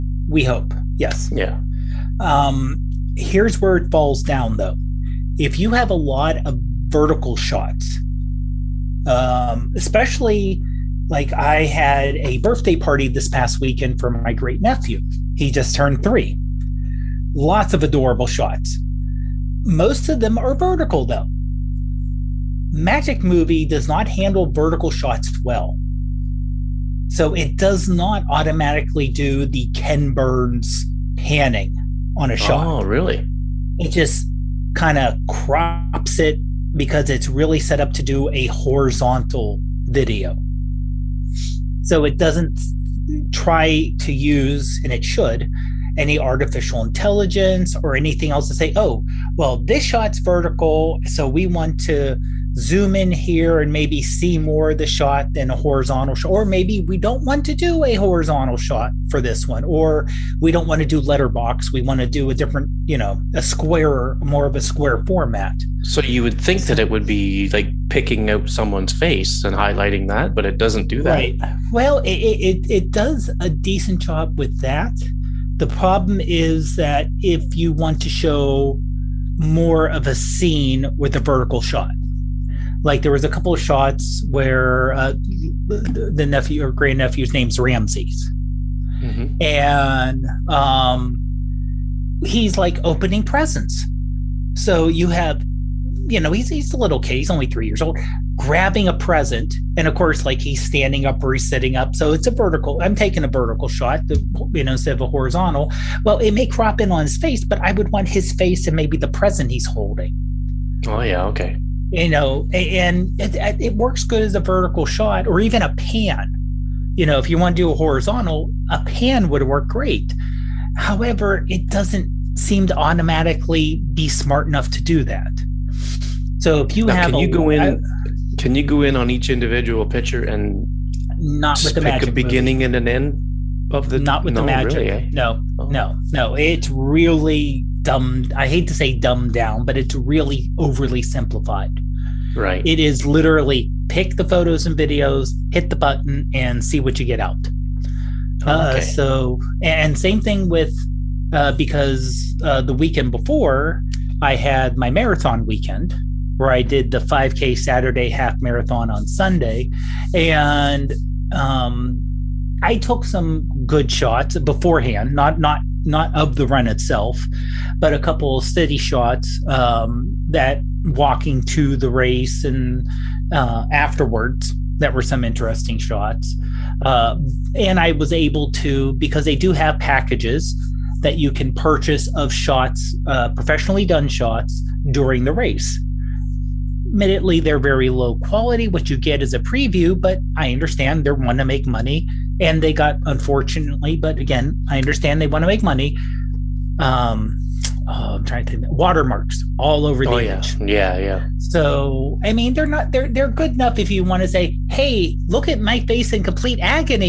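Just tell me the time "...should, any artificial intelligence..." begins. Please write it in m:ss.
0:45.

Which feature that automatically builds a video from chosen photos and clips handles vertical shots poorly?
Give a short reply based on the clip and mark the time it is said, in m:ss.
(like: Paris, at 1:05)
Magic Movie, at 0:22.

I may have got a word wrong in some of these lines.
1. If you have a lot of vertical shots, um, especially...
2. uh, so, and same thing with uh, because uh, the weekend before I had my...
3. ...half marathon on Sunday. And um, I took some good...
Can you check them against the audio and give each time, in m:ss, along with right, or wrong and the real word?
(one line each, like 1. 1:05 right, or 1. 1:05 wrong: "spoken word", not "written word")
1. 0:05 right
2. 2:28 right
3. 2:38 right.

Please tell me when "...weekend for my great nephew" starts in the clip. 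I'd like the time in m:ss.
0:13.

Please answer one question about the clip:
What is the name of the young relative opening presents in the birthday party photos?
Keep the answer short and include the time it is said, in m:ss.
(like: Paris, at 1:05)
Ramses, at 1:27.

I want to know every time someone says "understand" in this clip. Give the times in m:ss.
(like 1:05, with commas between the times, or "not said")
3:10, 3:14.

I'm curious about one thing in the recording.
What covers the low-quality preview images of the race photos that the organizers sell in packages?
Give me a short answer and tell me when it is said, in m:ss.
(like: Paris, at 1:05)
Watermarks, at 3:18.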